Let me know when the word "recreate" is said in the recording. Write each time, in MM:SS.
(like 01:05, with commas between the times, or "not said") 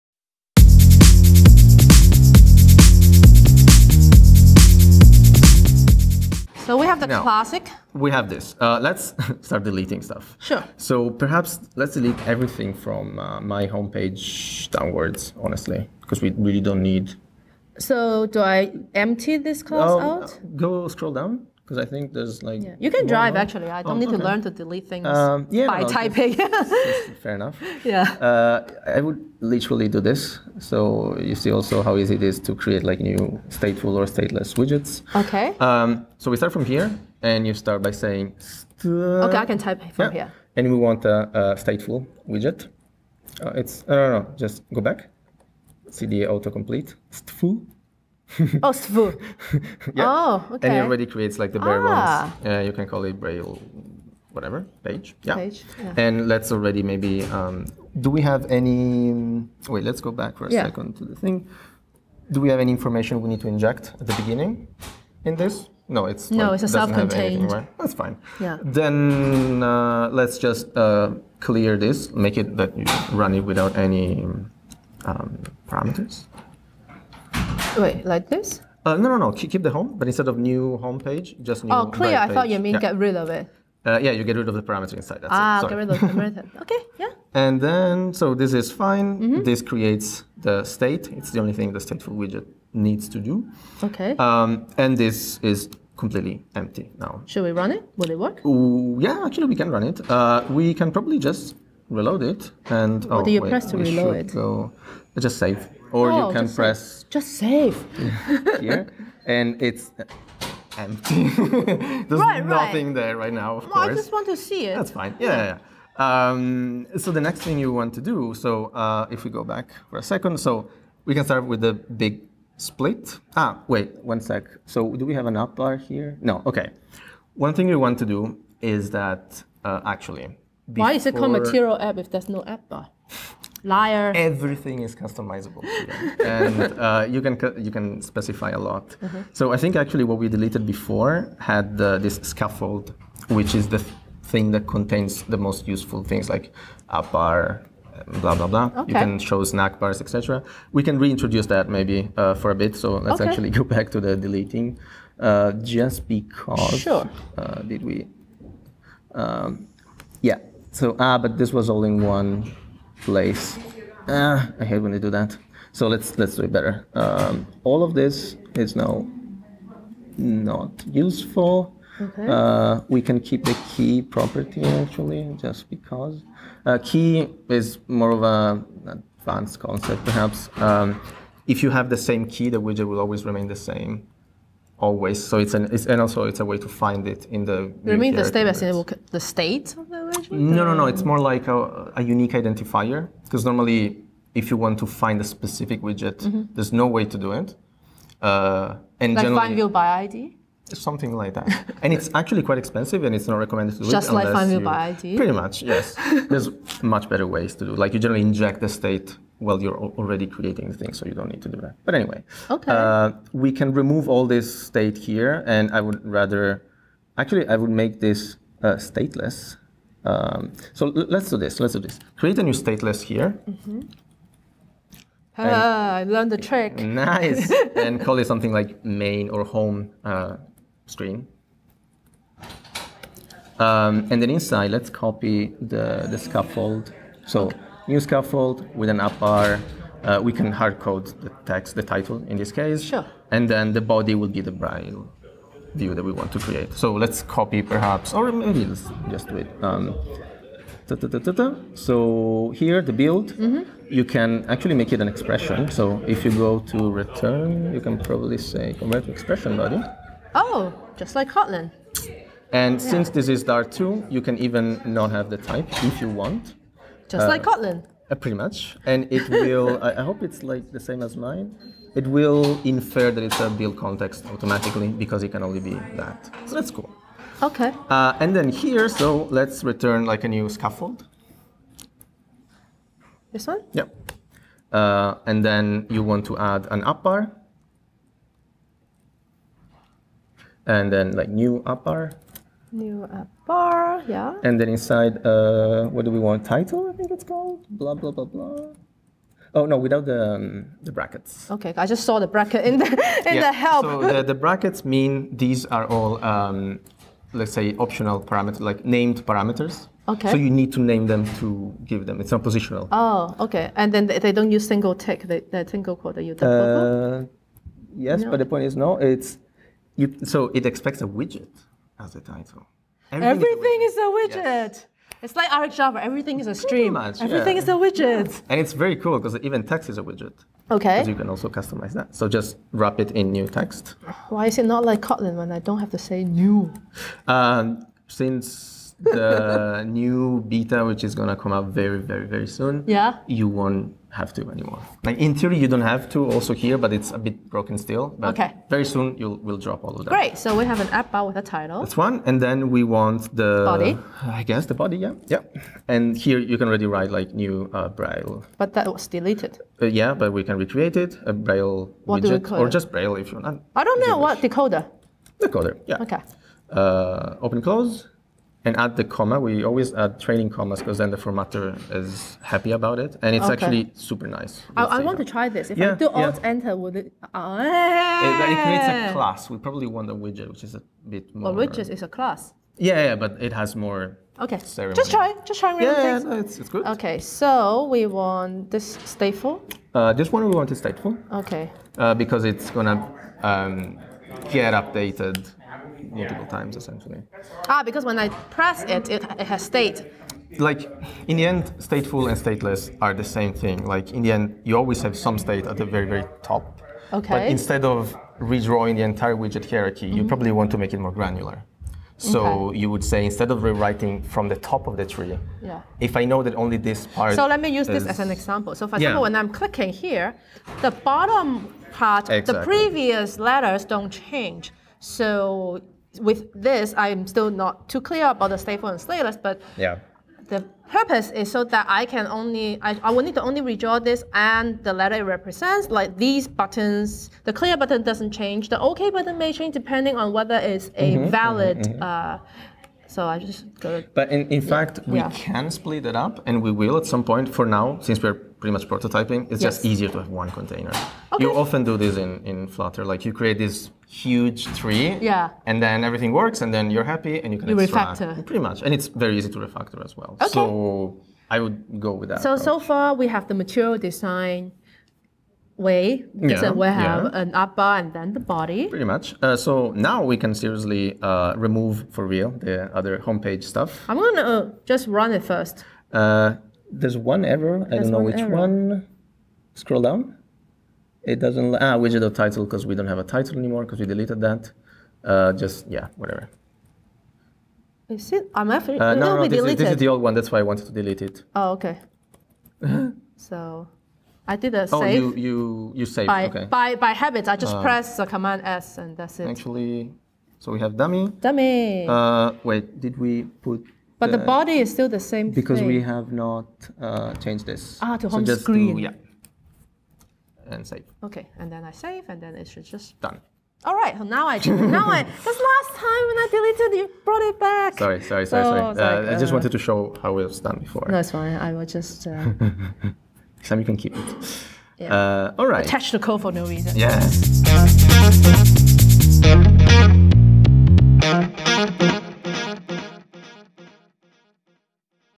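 06:00.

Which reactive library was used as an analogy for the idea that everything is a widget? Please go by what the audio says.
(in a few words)
RxJava.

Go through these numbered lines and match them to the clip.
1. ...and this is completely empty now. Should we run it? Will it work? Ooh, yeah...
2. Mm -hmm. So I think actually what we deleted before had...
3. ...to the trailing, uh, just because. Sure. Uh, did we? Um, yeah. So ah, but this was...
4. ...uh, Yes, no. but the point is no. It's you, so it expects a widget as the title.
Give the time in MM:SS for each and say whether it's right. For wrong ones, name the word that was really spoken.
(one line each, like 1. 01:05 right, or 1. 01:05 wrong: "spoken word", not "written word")
1. 01:34 right
2. 02:19 right
3. 02:33 wrong: "deleting", not "trailing"
4. 05:17 right.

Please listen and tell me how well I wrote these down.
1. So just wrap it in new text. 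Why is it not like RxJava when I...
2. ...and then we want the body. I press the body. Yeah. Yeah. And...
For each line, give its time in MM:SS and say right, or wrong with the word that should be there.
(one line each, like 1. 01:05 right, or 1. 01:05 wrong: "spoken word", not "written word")
1. 05:32 wrong: "Kotlin", not "RxJava"
2. 05:52 wrong: "guess", not "press".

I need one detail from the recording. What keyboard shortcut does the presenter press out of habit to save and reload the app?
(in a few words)
command S.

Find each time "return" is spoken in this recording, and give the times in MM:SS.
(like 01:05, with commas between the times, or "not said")
04:17, 04:39.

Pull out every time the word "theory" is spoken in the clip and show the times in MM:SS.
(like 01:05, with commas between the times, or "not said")
05:45.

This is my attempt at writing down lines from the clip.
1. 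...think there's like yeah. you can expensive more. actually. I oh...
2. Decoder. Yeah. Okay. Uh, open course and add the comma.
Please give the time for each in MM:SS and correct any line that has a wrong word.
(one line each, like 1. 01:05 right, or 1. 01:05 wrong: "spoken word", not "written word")
1. 00:21 wrong: "drive", not "expensive"
2. 06:05 wrong: "close", not "course".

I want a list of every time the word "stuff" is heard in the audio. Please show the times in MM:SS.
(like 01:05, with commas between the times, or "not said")
00:10, 07:53.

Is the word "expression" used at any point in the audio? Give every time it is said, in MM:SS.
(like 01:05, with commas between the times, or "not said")
04:15, 04:19.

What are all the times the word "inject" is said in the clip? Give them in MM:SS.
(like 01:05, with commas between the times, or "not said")
01:03, 03:28.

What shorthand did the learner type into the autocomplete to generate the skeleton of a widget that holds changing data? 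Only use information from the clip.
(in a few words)
svu.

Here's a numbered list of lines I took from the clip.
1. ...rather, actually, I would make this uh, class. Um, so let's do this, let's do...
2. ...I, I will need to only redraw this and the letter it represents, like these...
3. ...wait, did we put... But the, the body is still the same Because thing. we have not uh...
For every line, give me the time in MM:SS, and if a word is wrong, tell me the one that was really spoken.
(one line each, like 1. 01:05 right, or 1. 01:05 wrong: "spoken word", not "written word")
1. 03:36 wrong: "stateless", not "class"
2. 07:12 right
3. 08:22 right.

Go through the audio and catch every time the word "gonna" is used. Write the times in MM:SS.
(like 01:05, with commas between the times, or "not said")
05:41, 06:32, 07:54.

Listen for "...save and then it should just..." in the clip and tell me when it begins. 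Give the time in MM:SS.
08:31.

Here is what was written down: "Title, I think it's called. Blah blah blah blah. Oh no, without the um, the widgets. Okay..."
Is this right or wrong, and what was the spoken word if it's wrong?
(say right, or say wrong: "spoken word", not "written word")
wrong: "brackets", not "widgets".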